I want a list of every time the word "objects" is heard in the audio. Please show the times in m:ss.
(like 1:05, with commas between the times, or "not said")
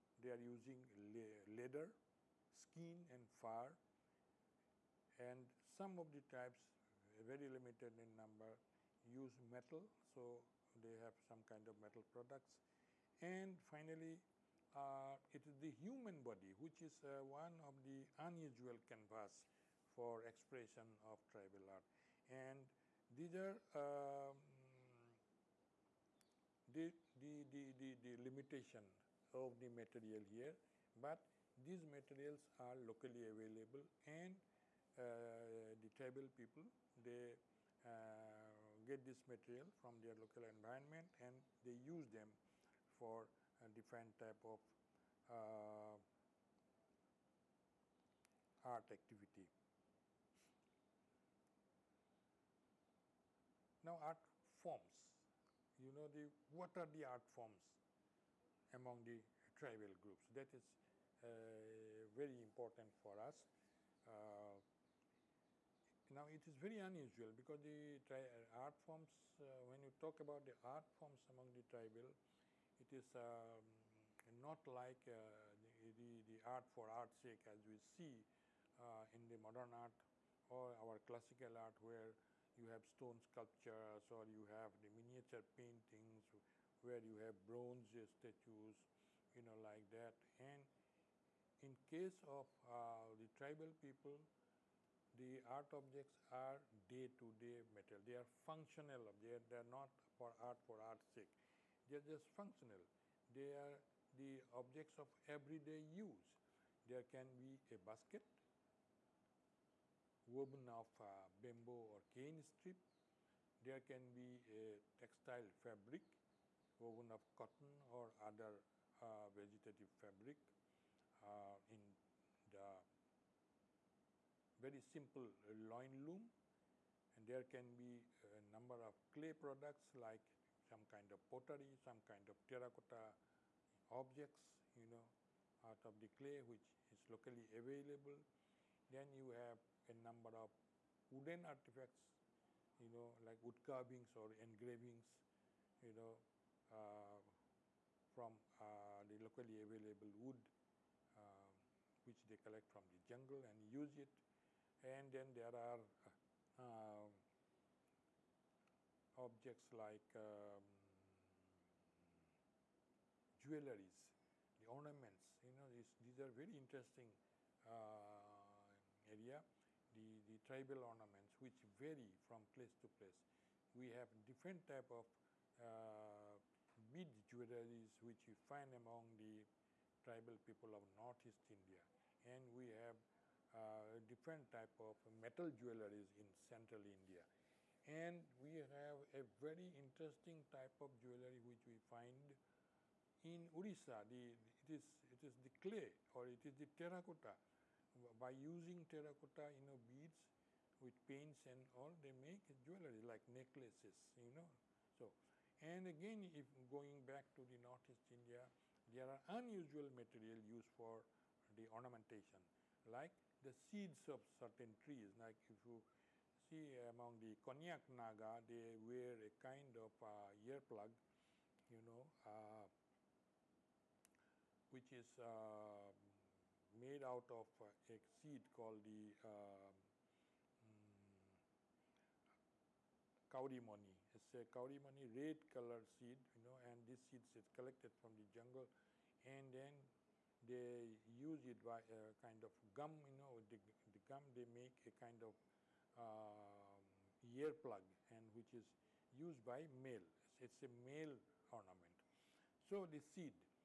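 1:35, 1:44, 2:13, 2:39.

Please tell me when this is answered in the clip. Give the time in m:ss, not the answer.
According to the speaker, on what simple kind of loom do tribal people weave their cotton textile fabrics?
2:05.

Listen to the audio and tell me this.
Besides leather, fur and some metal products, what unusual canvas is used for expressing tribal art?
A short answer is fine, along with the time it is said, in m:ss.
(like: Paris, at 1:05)
Human body, at 0:15.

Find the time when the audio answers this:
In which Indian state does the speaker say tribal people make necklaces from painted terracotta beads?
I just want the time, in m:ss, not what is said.
3:13.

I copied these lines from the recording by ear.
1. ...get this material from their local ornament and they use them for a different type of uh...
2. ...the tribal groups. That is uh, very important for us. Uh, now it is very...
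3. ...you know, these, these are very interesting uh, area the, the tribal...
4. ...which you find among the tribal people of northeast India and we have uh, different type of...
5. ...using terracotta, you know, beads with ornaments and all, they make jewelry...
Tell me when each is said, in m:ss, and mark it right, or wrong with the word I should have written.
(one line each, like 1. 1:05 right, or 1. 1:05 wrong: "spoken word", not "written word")
1. 0:38 wrong: "environment", not "ornament"
2. 0:59 right
3. 2:45 right
4. 2:58 right
5. 3:18 wrong: "paints", not "ornaments".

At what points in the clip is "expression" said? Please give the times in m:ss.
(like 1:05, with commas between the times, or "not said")
0:20.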